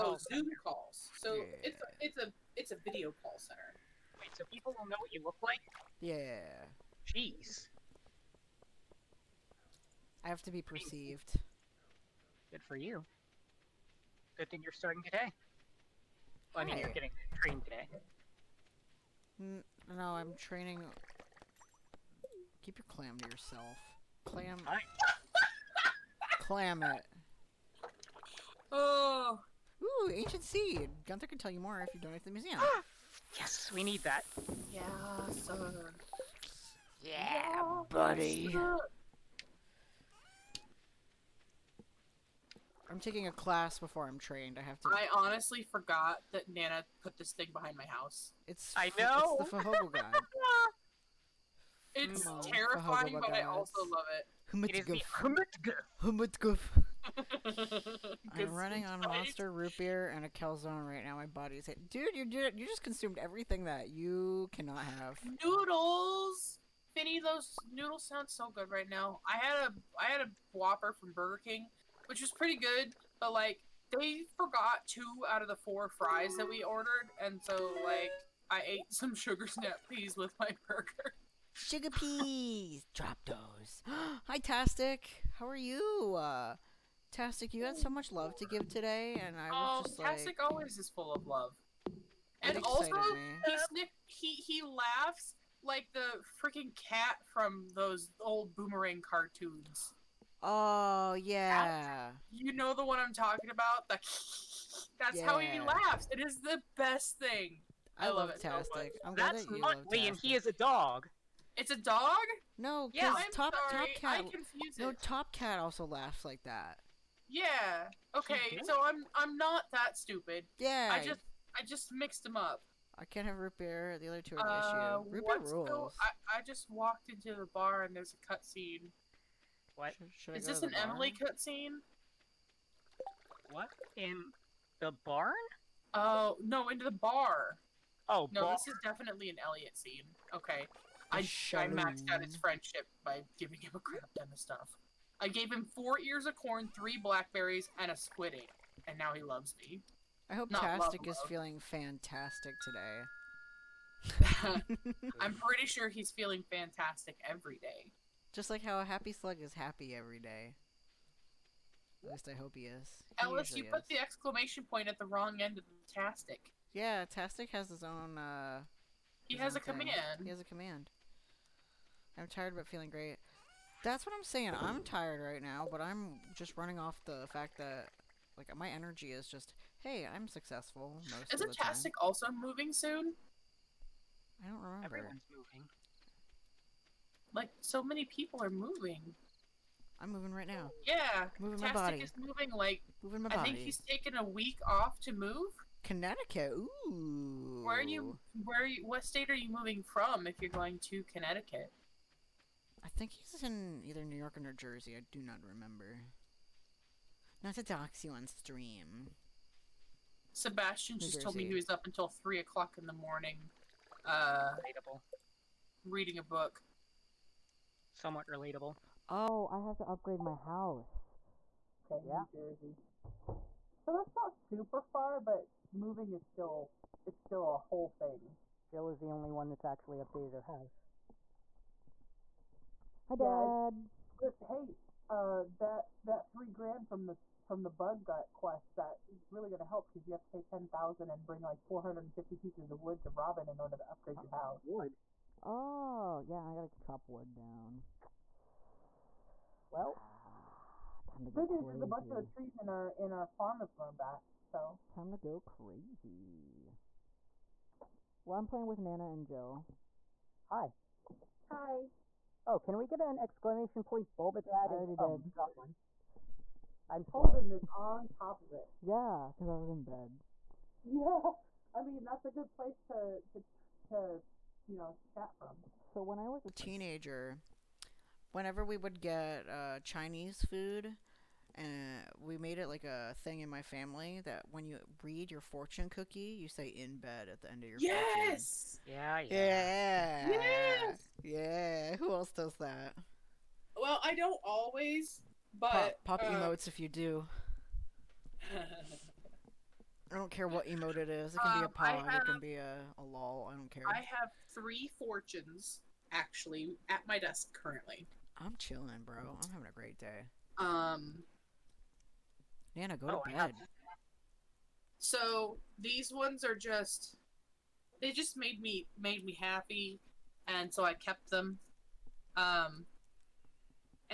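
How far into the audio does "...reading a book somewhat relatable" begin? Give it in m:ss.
3:35.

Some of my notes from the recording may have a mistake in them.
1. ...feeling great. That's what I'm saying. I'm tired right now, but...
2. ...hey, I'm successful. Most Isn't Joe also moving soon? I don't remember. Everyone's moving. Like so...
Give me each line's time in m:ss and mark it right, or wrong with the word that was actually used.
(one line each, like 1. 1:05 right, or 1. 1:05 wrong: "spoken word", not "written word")
1. 2:52 right
2. 2:59 wrong: "Tastic", not "Joe".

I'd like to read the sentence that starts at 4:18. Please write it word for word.
Well, I'm playing with Nana and Joe.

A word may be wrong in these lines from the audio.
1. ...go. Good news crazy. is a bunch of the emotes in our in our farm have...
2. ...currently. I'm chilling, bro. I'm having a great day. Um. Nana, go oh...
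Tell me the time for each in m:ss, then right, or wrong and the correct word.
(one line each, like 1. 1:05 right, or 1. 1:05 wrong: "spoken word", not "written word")
1. 4:11 wrong: "trees", not "emotes"
2. 5:07 right.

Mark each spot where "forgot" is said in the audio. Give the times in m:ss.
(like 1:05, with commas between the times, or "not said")
0:45, 1:14.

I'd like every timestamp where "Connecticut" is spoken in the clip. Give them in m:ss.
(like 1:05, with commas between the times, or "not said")
3:15, 3:21.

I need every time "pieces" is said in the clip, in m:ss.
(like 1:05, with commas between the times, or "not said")
4:02.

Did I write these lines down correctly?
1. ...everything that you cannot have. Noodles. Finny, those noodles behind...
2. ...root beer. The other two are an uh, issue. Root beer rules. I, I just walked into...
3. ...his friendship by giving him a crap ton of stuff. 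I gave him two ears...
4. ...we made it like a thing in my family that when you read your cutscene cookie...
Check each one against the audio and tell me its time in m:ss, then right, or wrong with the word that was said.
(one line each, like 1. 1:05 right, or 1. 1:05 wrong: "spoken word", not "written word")
1. 1:03 wrong: "sound", not "behind"
2. 2:03 right
3. 2:22 wrong: "four", not "two"
4. 4:42 wrong: "fortune", not "cutscene".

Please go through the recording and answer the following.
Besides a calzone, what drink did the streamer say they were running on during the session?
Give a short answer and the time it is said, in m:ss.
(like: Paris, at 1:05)
Monster Root Beer, at 0:58.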